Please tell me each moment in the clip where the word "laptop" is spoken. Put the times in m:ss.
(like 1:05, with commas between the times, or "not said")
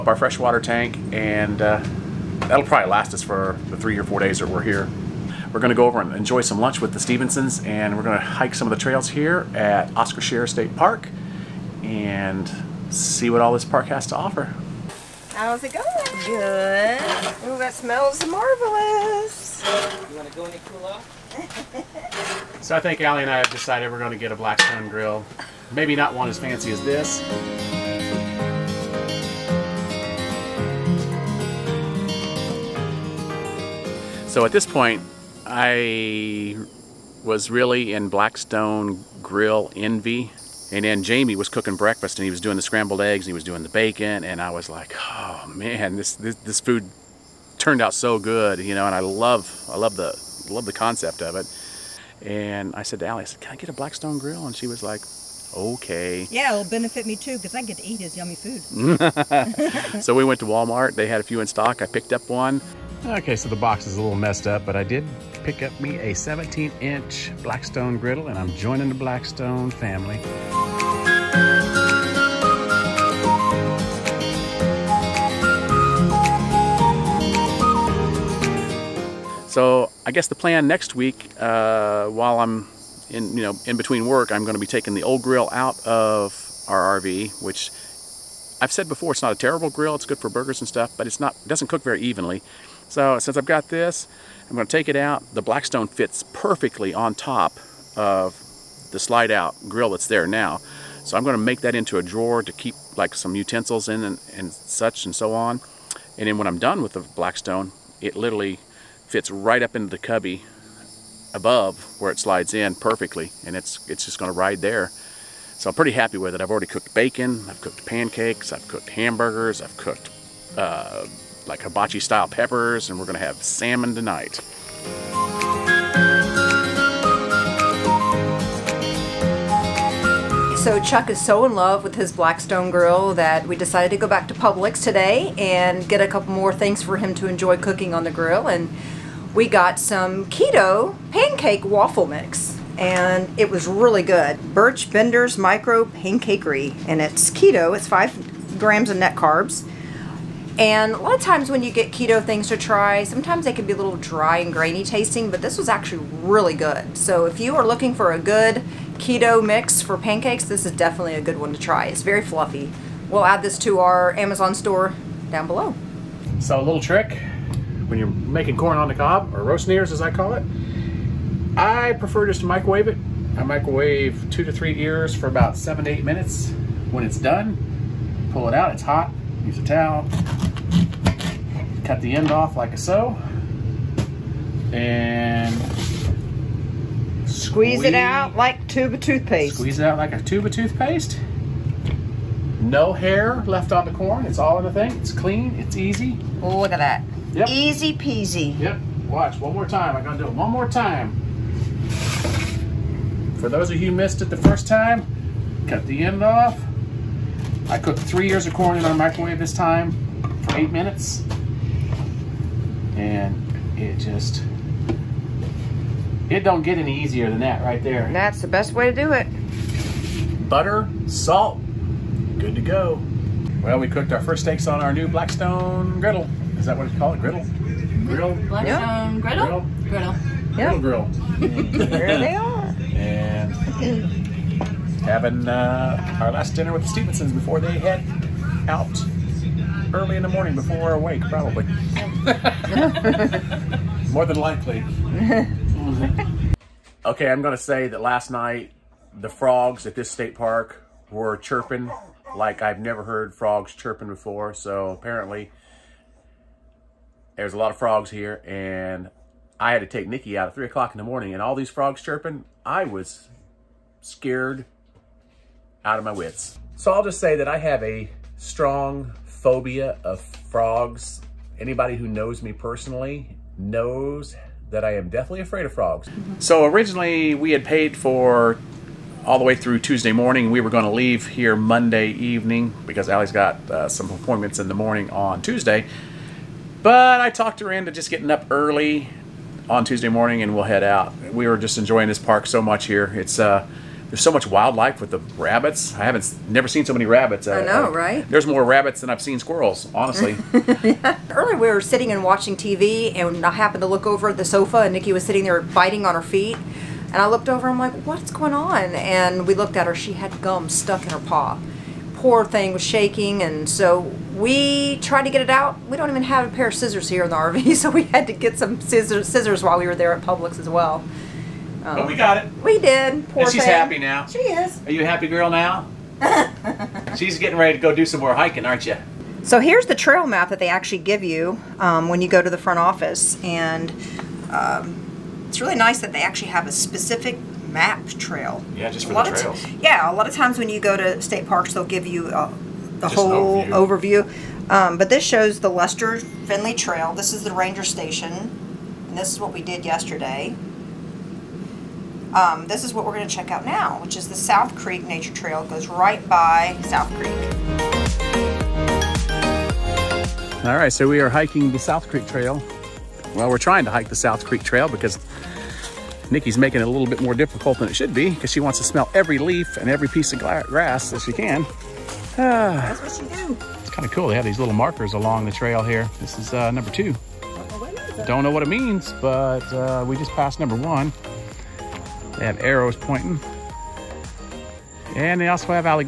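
not said.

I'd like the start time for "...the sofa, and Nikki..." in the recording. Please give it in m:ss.
5:04.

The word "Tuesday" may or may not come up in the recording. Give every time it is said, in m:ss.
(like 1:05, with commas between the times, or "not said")
4:39, 4:45, 4:49.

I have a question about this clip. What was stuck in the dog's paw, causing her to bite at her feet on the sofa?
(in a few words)
Gum.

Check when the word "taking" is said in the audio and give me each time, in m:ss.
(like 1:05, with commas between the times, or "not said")
1:24.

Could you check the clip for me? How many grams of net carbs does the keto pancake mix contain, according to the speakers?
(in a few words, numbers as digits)
5.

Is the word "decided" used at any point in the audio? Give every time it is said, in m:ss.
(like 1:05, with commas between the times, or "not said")
0:23, 2:13.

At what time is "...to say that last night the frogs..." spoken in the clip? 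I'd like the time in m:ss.
4:07.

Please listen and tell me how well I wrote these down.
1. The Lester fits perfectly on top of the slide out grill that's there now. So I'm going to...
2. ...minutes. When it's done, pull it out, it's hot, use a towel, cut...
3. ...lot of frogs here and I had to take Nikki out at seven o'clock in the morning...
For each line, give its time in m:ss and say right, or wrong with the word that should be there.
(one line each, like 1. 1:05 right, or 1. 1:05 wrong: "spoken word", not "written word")
1. 1:35 wrong: "Blackstone", not "Lester"
2. 2:56 right
3. 4:17 wrong: "three", not "seven".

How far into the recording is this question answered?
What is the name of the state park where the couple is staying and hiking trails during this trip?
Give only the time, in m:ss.
0:09.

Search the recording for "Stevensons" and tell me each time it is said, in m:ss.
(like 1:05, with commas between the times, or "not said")
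0:06, 3:56.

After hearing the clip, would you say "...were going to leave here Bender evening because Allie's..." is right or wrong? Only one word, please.
wrong.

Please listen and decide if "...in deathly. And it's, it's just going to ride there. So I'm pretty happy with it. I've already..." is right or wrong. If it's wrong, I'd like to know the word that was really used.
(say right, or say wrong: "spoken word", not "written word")
wrong: "perfectly", not "deathly".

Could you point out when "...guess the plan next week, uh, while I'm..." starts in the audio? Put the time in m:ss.
1:20.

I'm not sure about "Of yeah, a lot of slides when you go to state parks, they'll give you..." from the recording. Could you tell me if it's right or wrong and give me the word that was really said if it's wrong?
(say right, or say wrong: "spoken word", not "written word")
wrong: "times", not "slides".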